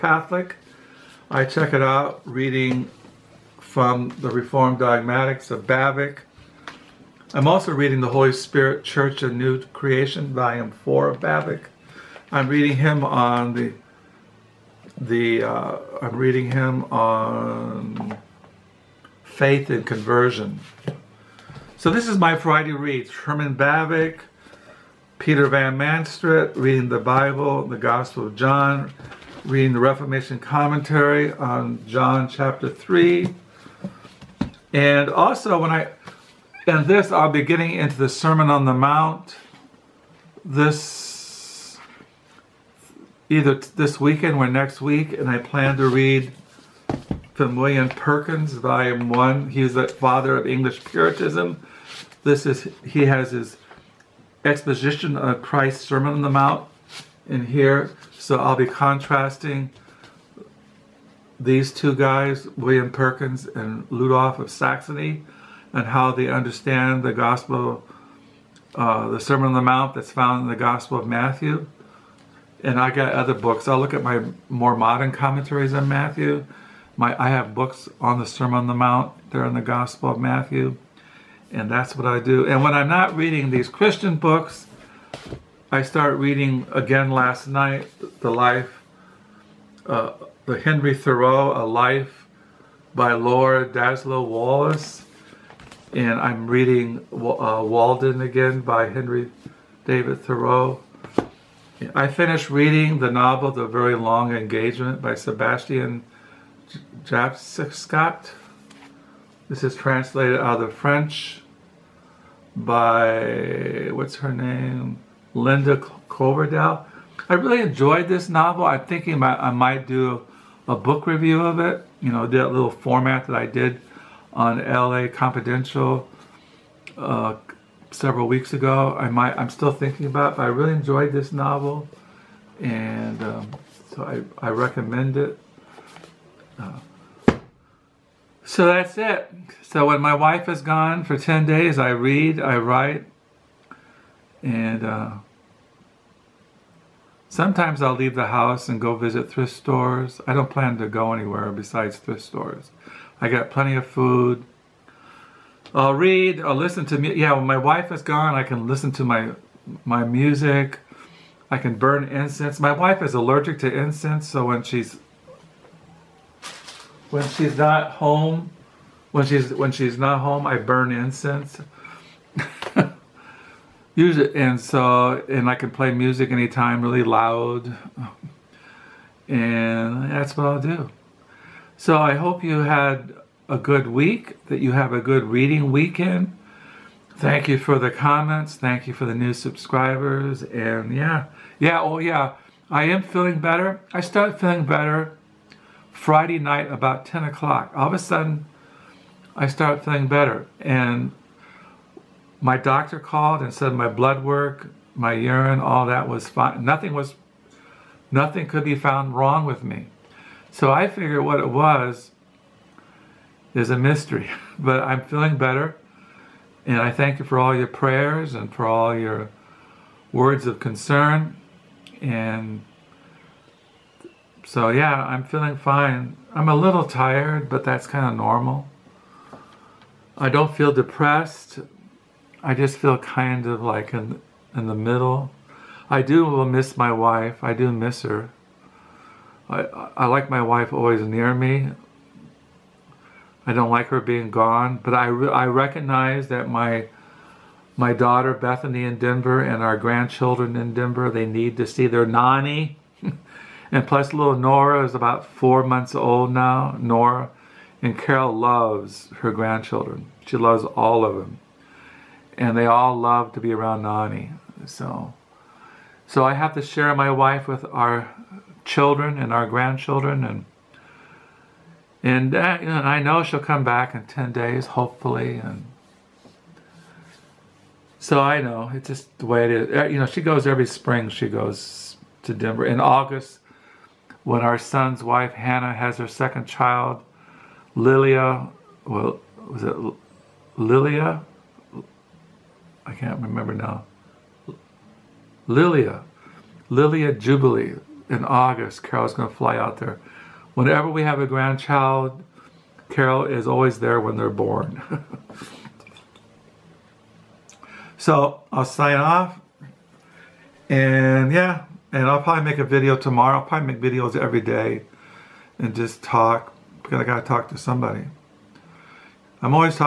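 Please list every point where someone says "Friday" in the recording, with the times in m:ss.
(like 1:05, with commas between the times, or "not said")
0:22, 3:15.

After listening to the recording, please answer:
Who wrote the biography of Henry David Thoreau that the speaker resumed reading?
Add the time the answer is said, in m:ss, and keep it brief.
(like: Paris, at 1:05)
Laura Dassow Wallace, at 1:33.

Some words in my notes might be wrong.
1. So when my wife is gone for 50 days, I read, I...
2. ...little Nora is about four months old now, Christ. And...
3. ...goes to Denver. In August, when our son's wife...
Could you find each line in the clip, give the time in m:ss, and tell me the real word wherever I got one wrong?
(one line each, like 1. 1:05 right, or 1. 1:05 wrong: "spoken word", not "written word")
1. 2:19 wrong: "10", not "50"
2. 4:14 wrong: "Nora", not "Christ"
3. 4:41 right.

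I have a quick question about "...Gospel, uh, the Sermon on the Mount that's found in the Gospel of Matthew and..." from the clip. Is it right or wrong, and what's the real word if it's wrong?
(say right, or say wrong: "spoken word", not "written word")
right.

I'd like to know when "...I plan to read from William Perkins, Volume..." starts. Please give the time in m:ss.
0:45.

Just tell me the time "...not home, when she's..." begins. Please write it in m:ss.
2:47.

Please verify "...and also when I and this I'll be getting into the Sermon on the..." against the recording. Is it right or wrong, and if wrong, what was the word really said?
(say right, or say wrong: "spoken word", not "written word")
right.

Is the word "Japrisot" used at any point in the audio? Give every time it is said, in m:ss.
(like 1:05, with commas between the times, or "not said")
1:47.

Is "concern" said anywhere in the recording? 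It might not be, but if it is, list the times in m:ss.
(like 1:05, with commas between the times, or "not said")
3:40.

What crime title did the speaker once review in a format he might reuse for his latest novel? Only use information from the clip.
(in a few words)
LA Confidential.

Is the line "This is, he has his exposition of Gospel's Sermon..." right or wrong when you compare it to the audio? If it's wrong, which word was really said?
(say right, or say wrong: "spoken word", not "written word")
wrong: "Christ", not "Gospel".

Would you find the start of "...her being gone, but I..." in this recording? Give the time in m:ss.
4:03.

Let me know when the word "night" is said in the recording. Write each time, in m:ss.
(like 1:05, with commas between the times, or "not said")
1:27, 3:16.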